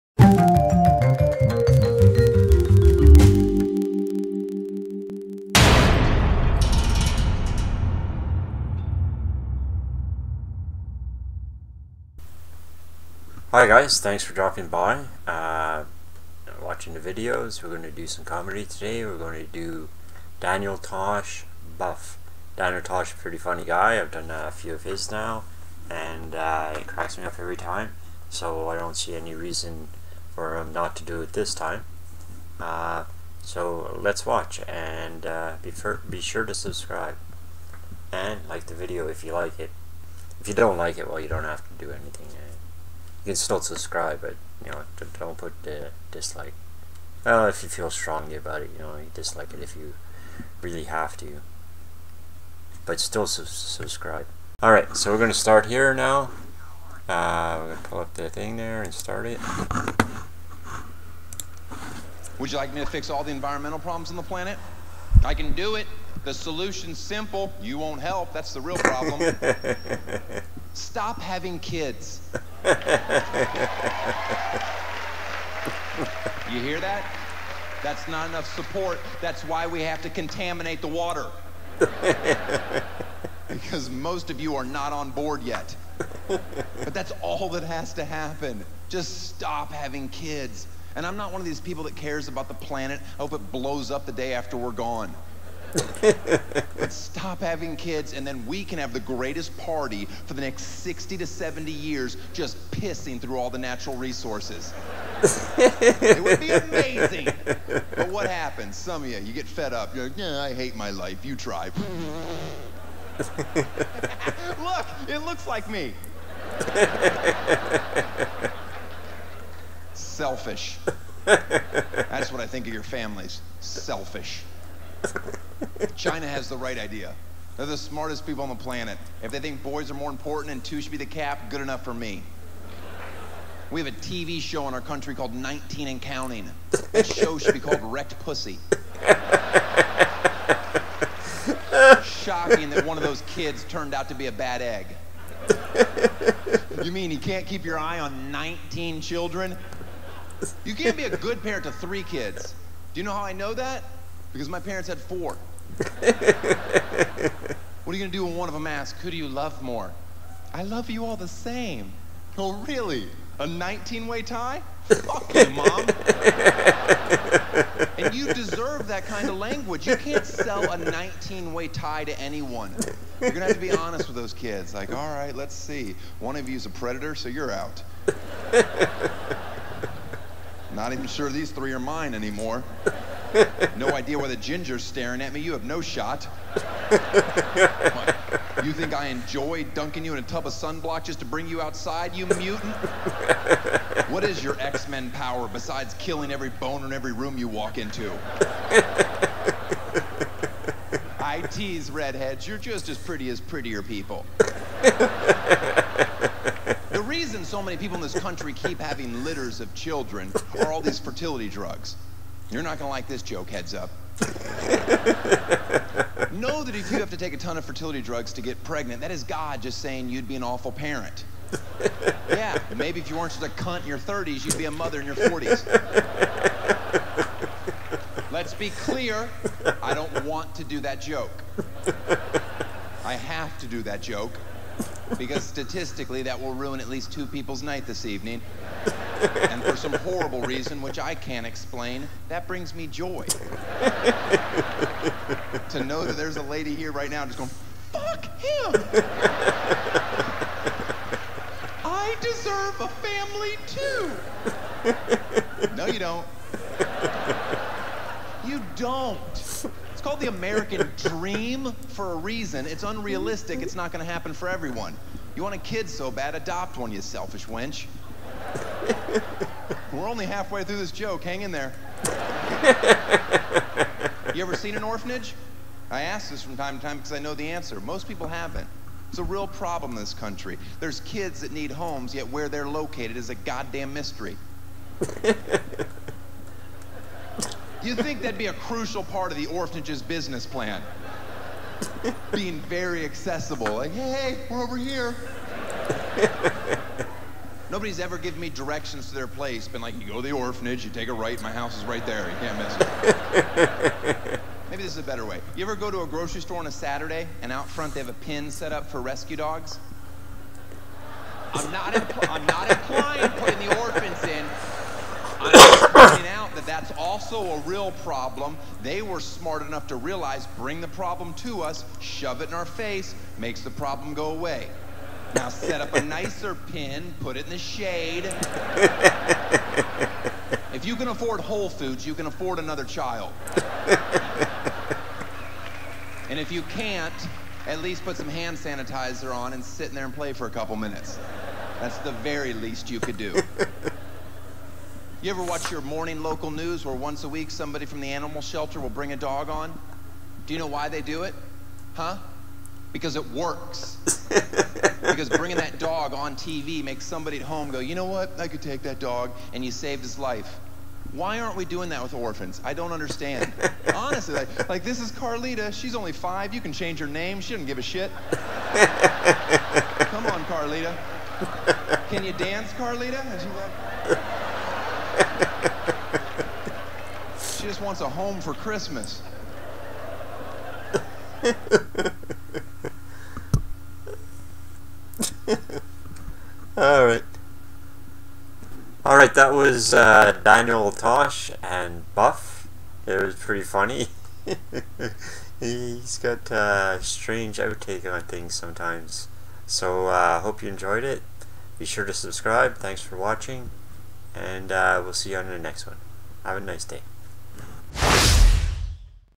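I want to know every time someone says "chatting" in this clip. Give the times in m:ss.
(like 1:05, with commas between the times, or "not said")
not said.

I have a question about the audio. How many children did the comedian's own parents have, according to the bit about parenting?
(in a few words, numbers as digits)
4.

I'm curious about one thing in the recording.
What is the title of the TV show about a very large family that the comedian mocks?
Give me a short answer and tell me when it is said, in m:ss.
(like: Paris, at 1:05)
19 and Counting, at 2:15.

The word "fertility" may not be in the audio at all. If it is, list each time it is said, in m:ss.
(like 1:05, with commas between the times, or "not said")
3:30, 3:37.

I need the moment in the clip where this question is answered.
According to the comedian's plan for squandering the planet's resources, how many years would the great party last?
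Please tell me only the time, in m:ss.
1:40.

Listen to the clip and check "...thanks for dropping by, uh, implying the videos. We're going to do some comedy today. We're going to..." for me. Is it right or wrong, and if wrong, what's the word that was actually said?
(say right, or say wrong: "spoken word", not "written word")
wrong: "watching", not "implying".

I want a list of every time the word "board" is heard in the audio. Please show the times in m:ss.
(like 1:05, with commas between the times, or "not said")
1:25.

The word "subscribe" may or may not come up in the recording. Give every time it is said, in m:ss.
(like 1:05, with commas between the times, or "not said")
0:36, 0:43, 0:53, 6:42.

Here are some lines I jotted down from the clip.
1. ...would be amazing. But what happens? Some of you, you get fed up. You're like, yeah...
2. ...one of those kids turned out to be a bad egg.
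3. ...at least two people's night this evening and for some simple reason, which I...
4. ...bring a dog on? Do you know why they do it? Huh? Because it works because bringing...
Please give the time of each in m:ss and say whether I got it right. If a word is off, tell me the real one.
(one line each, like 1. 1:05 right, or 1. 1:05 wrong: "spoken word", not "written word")
1. 1:46 right
2. 2:22 right
3. 3:56 wrong: "horrible", not "simple"
4. 5:48 right.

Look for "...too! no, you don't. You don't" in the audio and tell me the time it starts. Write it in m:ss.
4:13.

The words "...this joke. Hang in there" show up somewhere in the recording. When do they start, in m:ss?
4:30.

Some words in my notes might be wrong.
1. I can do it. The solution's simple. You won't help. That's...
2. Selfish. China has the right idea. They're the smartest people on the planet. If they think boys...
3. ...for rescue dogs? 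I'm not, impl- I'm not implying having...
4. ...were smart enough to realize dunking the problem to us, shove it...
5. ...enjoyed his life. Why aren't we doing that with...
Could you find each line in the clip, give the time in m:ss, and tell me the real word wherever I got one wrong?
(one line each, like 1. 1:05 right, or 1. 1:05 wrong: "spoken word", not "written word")
1. 1:05 right
2. 2:03 right
3. 5:08 wrong: "putting", not "having"
4. 5:19 wrong: "bring", not "dunking"
5. 5:59 wrong: "saved", not "enjoyed".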